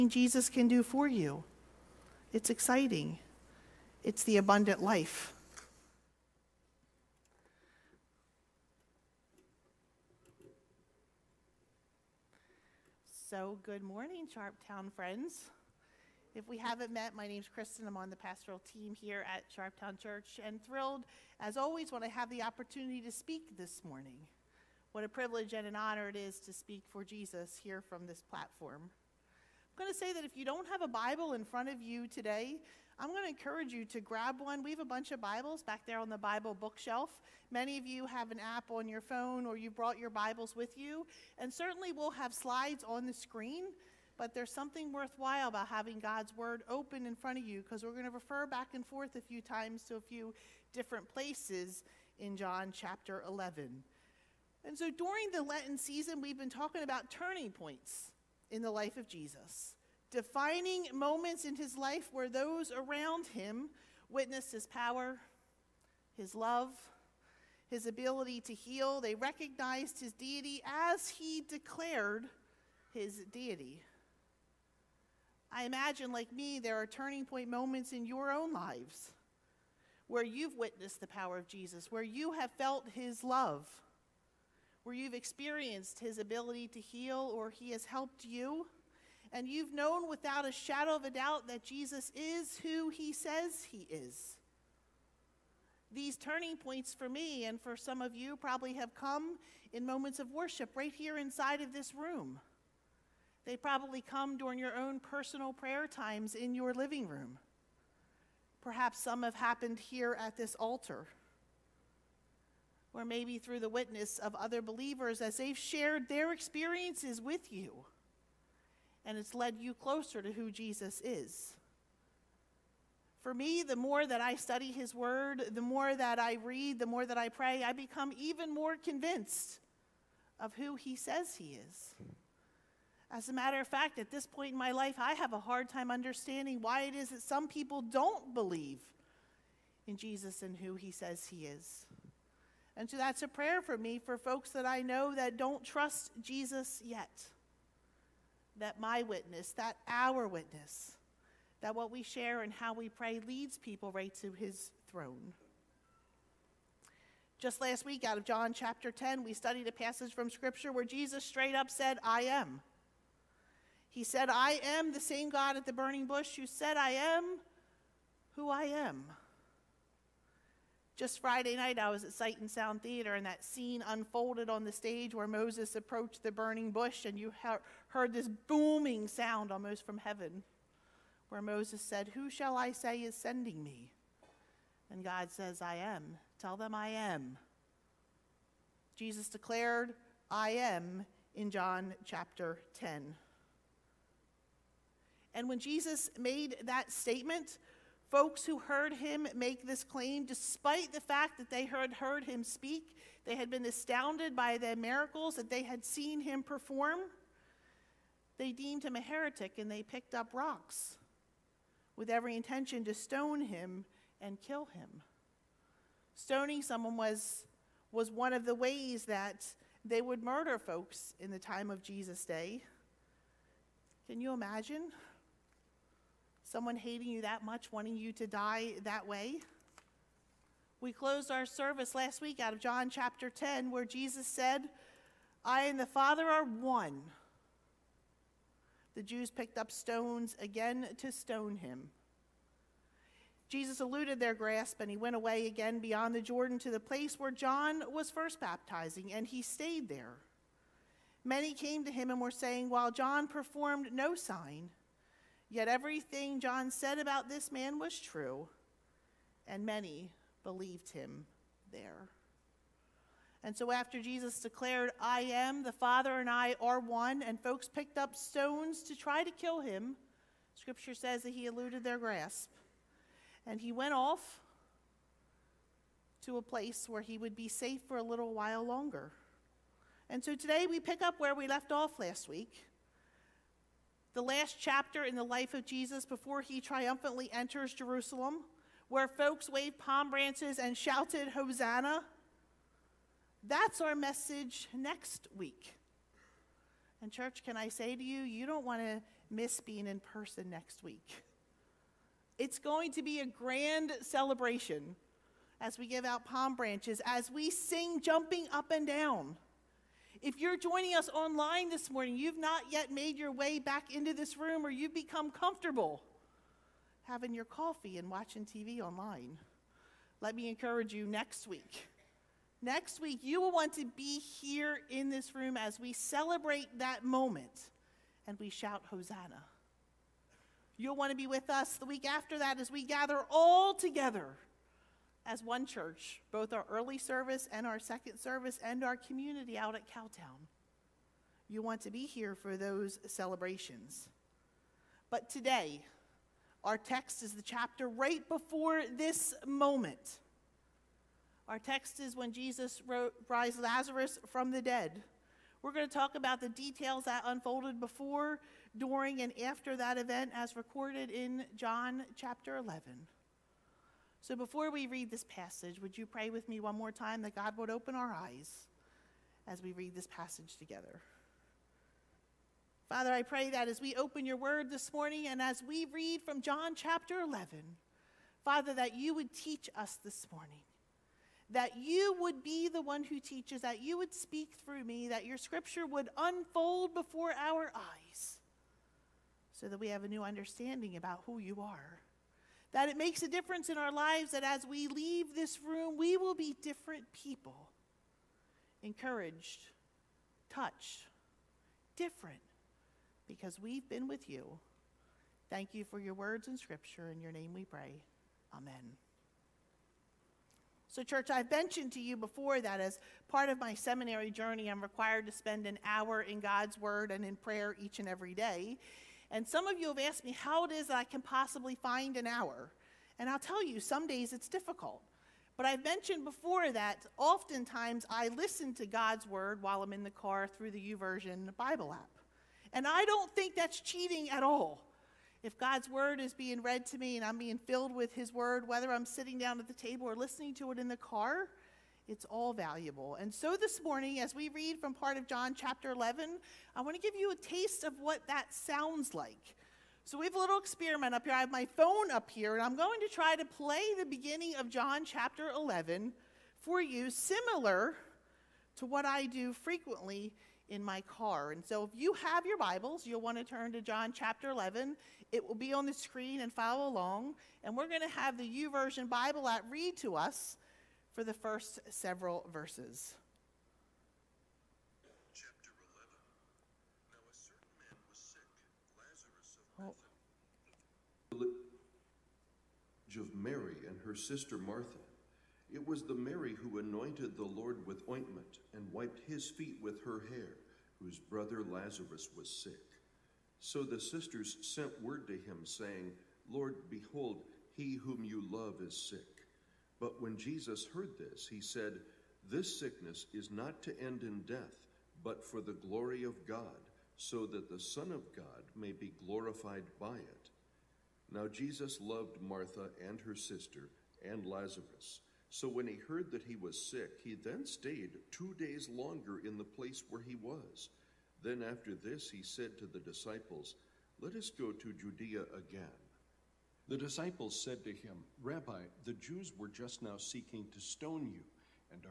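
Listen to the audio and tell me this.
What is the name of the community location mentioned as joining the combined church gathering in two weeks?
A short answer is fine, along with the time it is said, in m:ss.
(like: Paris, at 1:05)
Cowtown, at 5:39.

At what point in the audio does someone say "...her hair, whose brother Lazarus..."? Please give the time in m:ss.
8:10.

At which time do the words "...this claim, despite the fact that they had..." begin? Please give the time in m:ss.
3:19.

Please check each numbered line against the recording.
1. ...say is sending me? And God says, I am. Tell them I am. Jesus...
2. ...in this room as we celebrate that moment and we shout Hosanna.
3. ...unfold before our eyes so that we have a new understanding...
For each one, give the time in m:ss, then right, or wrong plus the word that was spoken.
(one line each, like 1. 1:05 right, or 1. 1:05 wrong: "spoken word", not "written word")
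1. 3:02 right
2. 5:24 right
3. 6:26 right.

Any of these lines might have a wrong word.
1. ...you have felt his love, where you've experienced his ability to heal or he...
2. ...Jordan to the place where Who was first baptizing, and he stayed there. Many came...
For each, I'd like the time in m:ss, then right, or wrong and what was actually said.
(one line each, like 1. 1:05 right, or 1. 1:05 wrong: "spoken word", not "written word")
1. 1:22 right
2. 4:06 wrong: "John", not "Who".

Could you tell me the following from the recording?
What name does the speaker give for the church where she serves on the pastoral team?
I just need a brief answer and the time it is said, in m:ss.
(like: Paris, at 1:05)
Sharptown Church, at 0:19.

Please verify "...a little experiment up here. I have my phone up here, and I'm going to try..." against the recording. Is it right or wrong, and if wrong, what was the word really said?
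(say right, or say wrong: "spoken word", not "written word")
right.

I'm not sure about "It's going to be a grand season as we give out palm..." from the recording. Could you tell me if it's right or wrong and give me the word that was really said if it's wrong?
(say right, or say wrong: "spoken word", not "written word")
wrong: "celebration", not "season".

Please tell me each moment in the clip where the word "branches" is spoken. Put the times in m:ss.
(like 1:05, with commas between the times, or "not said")
4:50, 5:06.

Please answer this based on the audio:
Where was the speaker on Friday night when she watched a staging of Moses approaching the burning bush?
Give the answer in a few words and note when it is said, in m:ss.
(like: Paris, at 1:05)
Sight and Sound Theater, at 2:52.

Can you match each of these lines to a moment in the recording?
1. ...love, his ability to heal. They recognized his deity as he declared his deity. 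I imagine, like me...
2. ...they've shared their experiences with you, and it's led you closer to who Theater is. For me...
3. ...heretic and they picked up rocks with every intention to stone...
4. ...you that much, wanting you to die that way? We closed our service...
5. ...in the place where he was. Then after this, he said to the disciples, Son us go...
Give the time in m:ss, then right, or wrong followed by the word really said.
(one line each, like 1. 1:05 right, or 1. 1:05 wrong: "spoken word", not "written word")
1. 1:06 right
2. 1:55 wrong: "Jesus", not "Theater"
3. 3:29 right
4. 3:47 right
5. 8:39 wrong: "Let", not "Son".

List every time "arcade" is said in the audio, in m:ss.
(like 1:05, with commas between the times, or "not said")
not said.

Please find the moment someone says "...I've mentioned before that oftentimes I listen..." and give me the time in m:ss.
7:05.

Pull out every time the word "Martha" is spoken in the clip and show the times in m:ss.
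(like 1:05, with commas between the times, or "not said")
8:04, 8:32.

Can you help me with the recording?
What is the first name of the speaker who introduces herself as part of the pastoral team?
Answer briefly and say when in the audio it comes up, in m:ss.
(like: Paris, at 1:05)
Kristen, at 0:17.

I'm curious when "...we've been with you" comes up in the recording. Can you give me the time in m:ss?
6:43.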